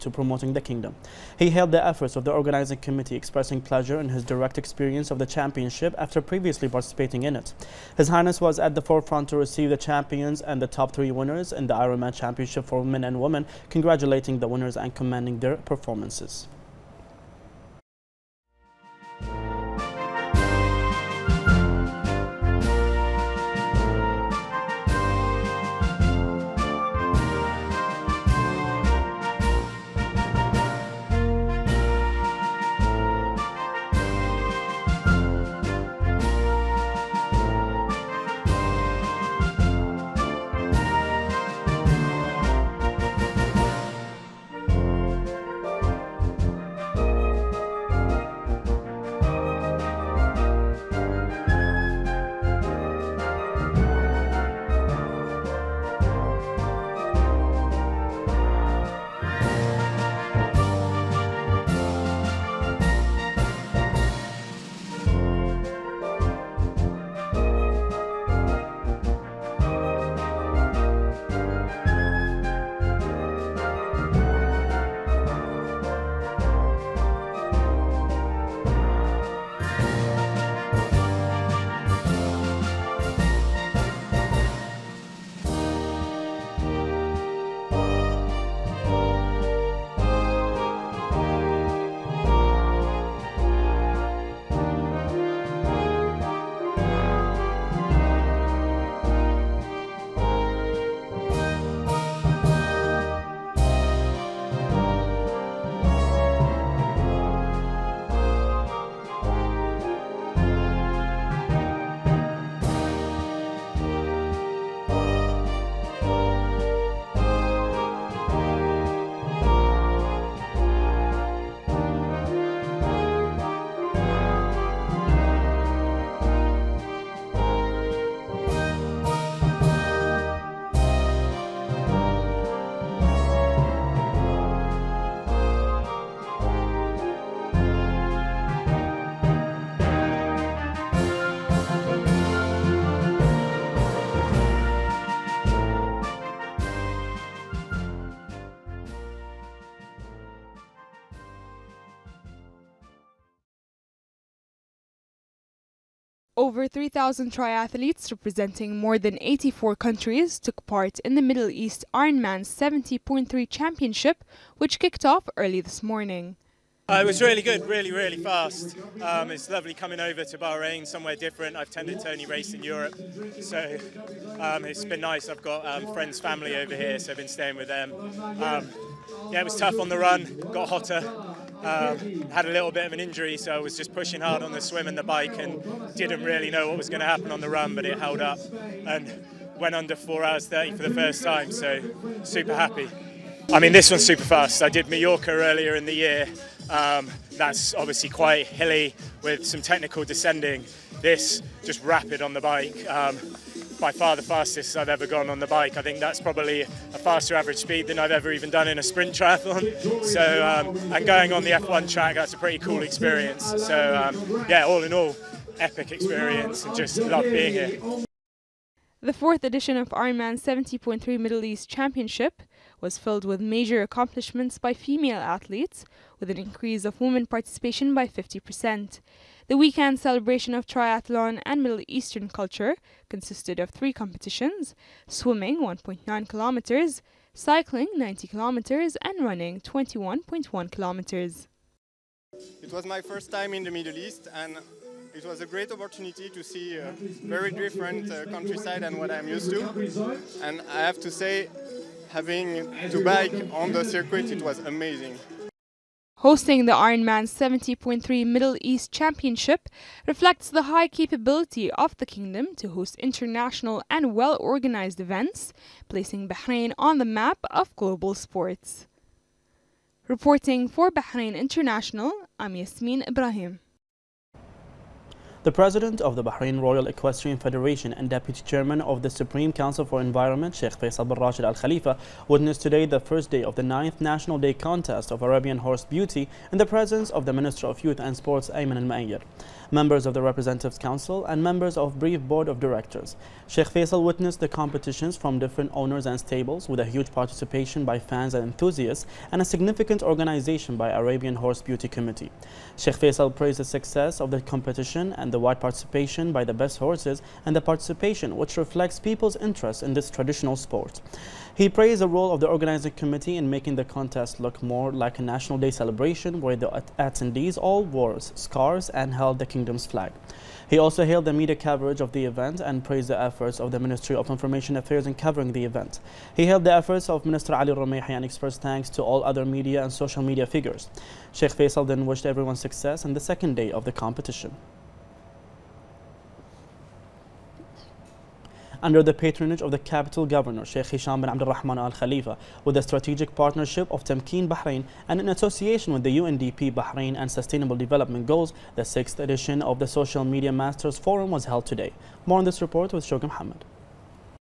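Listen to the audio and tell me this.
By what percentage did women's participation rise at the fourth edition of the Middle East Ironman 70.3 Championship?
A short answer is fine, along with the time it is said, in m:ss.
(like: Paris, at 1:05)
50%, at 3:48.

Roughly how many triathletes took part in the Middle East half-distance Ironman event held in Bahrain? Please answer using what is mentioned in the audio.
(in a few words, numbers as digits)
Over 3,000.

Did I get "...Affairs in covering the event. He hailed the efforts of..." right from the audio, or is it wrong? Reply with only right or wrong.
right.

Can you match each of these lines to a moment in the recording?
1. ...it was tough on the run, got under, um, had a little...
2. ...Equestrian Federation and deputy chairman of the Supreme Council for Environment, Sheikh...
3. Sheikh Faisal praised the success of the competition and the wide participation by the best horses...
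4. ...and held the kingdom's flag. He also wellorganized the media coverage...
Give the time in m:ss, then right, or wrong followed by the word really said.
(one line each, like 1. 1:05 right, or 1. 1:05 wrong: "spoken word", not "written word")
1. 2:59 wrong: "hotter", not "under"
2. 4:36 right
3. 5:02 right
4. 5:18 wrong: "hailed", not "wellorganized".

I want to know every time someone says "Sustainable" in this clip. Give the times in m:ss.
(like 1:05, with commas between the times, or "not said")
5:47.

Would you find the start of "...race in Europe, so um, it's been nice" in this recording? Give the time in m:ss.
2:52.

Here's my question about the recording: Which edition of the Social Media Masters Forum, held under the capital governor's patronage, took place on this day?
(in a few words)
Sixth.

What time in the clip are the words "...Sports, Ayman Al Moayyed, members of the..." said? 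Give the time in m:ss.
4:48.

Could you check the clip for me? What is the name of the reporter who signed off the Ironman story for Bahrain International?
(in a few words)
Yasmin Ibrahim.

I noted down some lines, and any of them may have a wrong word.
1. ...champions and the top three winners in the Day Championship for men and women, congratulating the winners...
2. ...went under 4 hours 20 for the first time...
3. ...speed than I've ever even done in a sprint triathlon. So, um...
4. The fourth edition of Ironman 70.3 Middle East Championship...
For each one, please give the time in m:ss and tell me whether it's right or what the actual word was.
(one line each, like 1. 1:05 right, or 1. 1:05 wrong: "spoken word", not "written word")
1. 0:09 wrong: "Ironman", not "Day"
2. 3:09 wrong: "30", not "20"
3. 3:27 right
4. 3:39 right.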